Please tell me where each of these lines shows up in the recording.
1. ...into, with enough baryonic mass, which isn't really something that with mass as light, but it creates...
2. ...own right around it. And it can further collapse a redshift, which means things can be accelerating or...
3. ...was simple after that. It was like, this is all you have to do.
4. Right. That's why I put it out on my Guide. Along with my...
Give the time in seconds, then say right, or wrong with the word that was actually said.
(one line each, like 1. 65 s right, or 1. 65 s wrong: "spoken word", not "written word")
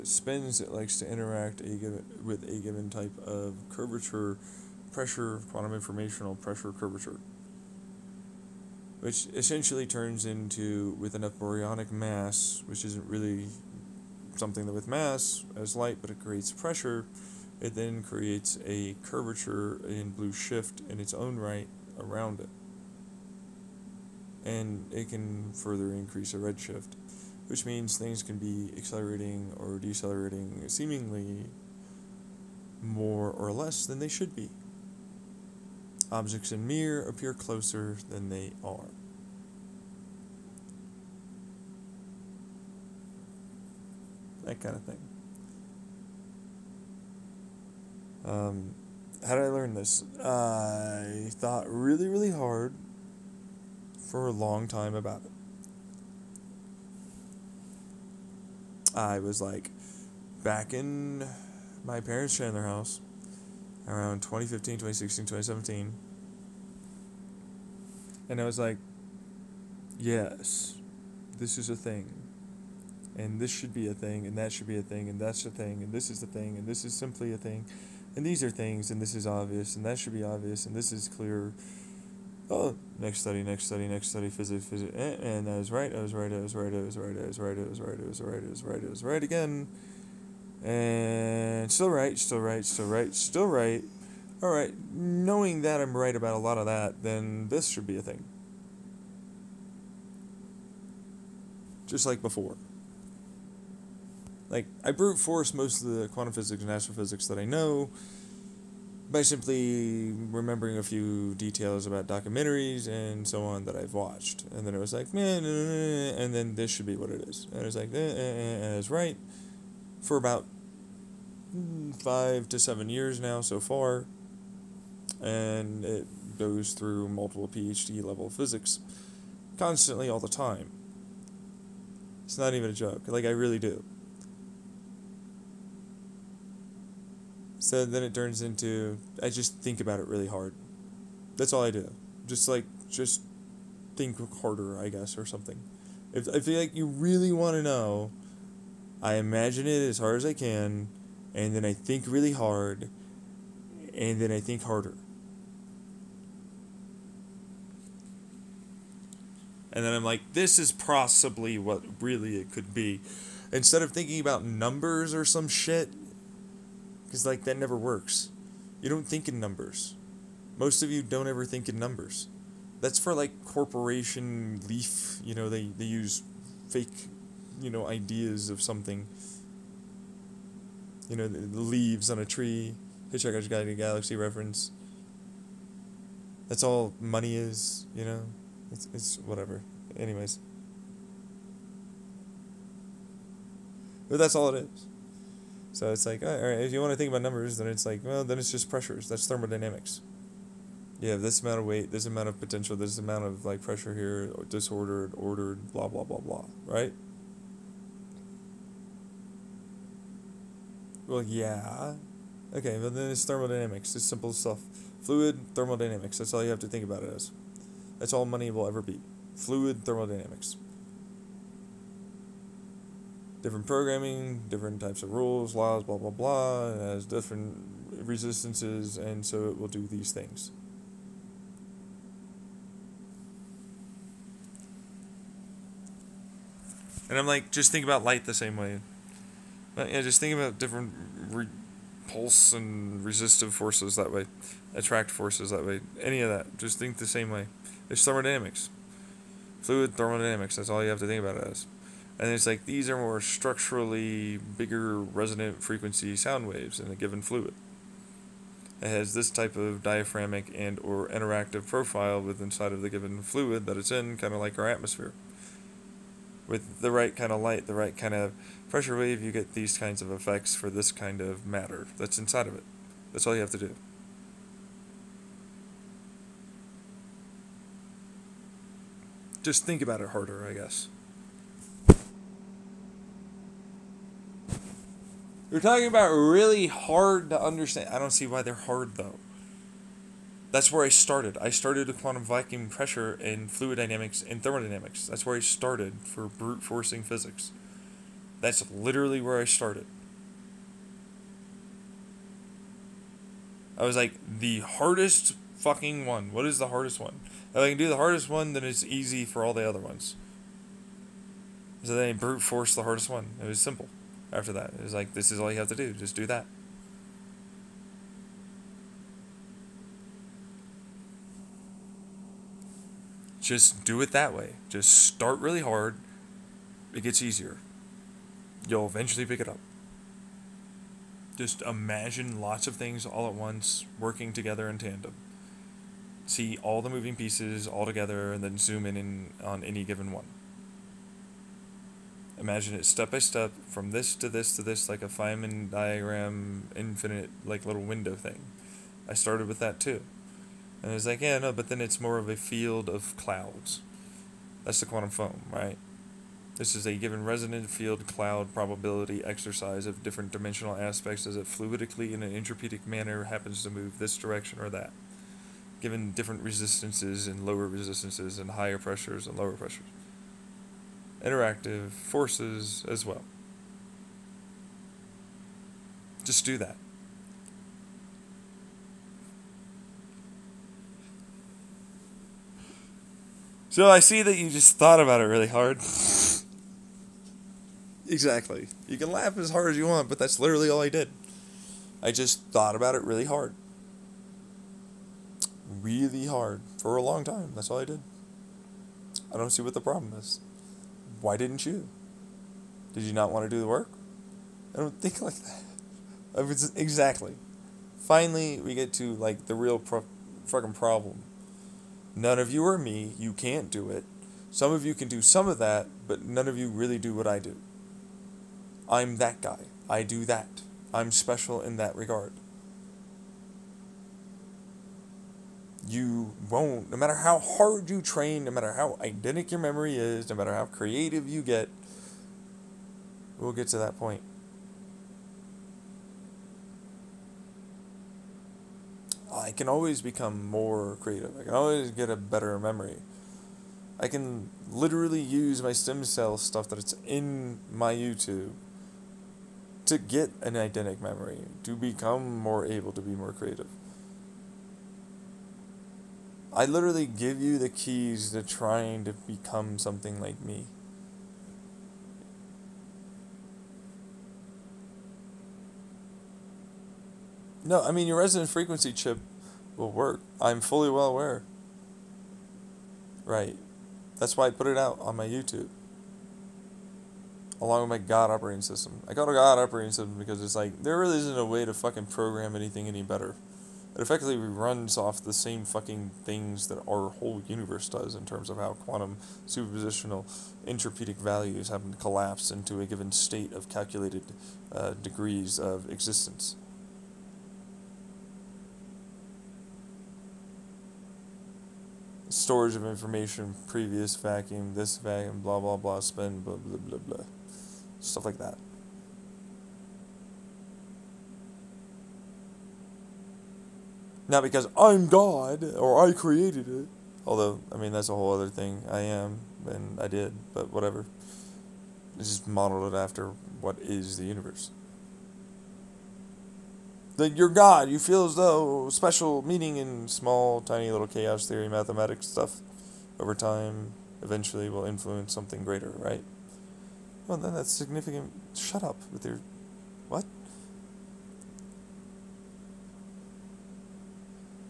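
1. 10 s right
2. 21 s wrong: "increase", not "collapse"
3. 313 s right
4. 473 s wrong: "YouTube", not "Guide".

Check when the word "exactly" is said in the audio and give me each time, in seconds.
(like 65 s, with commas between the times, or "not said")
388 s, 406 s.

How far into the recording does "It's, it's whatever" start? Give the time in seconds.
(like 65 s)
188 s.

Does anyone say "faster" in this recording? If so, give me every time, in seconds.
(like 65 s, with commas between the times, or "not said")
not said.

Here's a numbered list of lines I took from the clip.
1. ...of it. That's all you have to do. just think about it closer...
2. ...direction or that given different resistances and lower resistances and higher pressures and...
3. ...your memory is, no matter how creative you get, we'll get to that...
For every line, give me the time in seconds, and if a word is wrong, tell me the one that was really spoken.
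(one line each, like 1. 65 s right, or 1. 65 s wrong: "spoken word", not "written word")
1. 272 s wrong: "harder", not "closer"
2. 364 s right
3. 429 s right.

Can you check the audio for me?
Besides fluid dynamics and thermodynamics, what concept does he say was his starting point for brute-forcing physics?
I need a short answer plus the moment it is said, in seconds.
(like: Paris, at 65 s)
quantum vacuum pressure, at 291 s.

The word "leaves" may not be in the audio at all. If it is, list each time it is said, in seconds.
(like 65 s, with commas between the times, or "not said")
181 s.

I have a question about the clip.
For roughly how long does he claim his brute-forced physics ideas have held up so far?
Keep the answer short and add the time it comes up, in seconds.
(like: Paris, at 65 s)
5 to 7 years, at 122 s.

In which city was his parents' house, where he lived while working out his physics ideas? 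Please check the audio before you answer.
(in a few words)
Chandler.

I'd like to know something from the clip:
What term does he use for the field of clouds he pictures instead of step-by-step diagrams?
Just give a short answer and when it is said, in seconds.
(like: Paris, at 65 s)
quantum foam, at 354 s.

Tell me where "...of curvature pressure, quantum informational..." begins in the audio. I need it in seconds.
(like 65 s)
3 s.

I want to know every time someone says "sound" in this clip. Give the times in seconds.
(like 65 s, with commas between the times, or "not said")
256 s.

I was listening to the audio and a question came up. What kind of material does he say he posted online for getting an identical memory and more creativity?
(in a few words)
stem cell stuff.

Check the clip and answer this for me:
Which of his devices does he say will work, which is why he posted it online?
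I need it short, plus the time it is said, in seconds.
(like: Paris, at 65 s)
resonant frequency chip, at 468 s.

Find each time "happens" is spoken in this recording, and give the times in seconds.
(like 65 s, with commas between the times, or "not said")
363 s, 491 s.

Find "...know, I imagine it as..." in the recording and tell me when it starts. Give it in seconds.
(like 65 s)
147 s.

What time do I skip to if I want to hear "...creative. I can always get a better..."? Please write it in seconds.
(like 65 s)
440 s.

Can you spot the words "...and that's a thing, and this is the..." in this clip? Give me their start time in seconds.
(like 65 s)
75 s.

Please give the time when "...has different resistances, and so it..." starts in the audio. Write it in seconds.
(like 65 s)
226 s.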